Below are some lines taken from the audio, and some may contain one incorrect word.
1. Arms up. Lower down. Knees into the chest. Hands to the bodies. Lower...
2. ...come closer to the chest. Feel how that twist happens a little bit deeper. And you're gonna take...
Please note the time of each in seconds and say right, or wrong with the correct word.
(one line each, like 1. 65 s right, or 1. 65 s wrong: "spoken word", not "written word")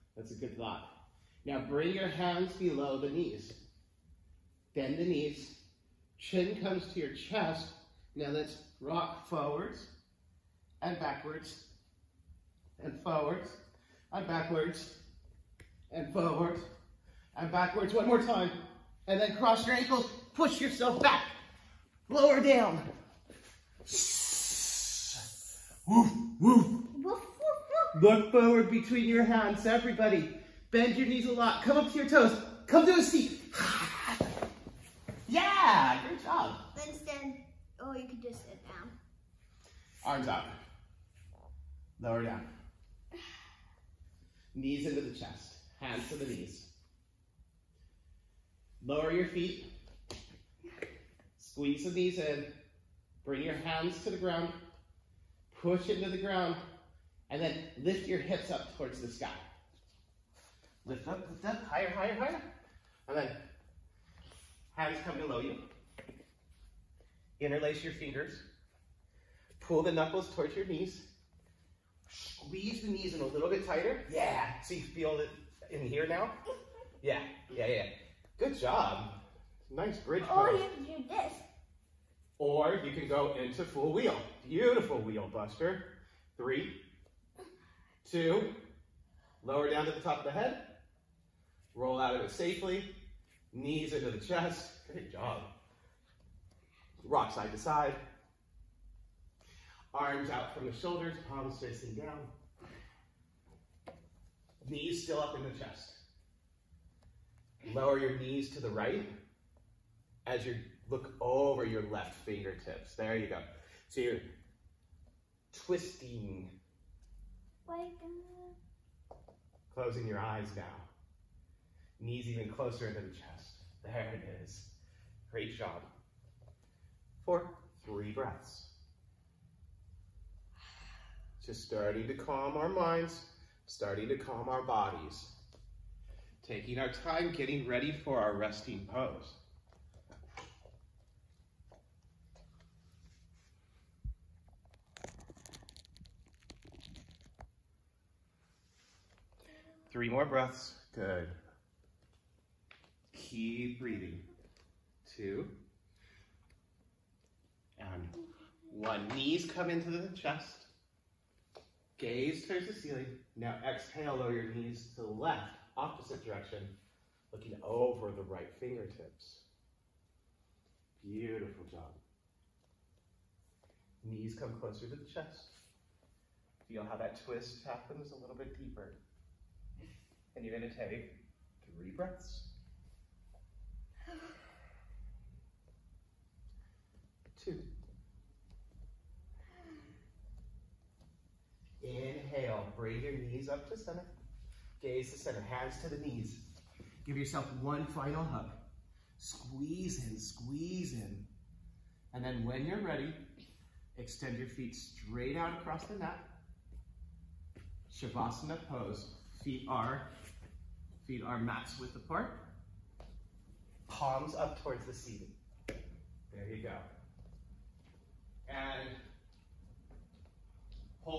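1. 40 s wrong: "knees", not "bodies"
2. 174 s right.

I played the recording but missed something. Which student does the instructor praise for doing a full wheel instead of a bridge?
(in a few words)
Buster.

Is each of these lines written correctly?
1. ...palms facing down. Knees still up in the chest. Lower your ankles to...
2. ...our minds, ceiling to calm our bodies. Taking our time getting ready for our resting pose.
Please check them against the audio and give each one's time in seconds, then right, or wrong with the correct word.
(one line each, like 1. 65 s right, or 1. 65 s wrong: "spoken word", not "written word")
1. 101 s wrong: "knees", not "ankles"
2. 132 s wrong: "starting", not "ceiling".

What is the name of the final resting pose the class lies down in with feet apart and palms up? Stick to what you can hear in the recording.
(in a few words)
Shavasana.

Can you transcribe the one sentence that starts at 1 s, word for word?
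Now bring your hands below the knees.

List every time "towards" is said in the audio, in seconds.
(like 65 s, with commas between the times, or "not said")
58 s, 70 s, 162 s, 214 s.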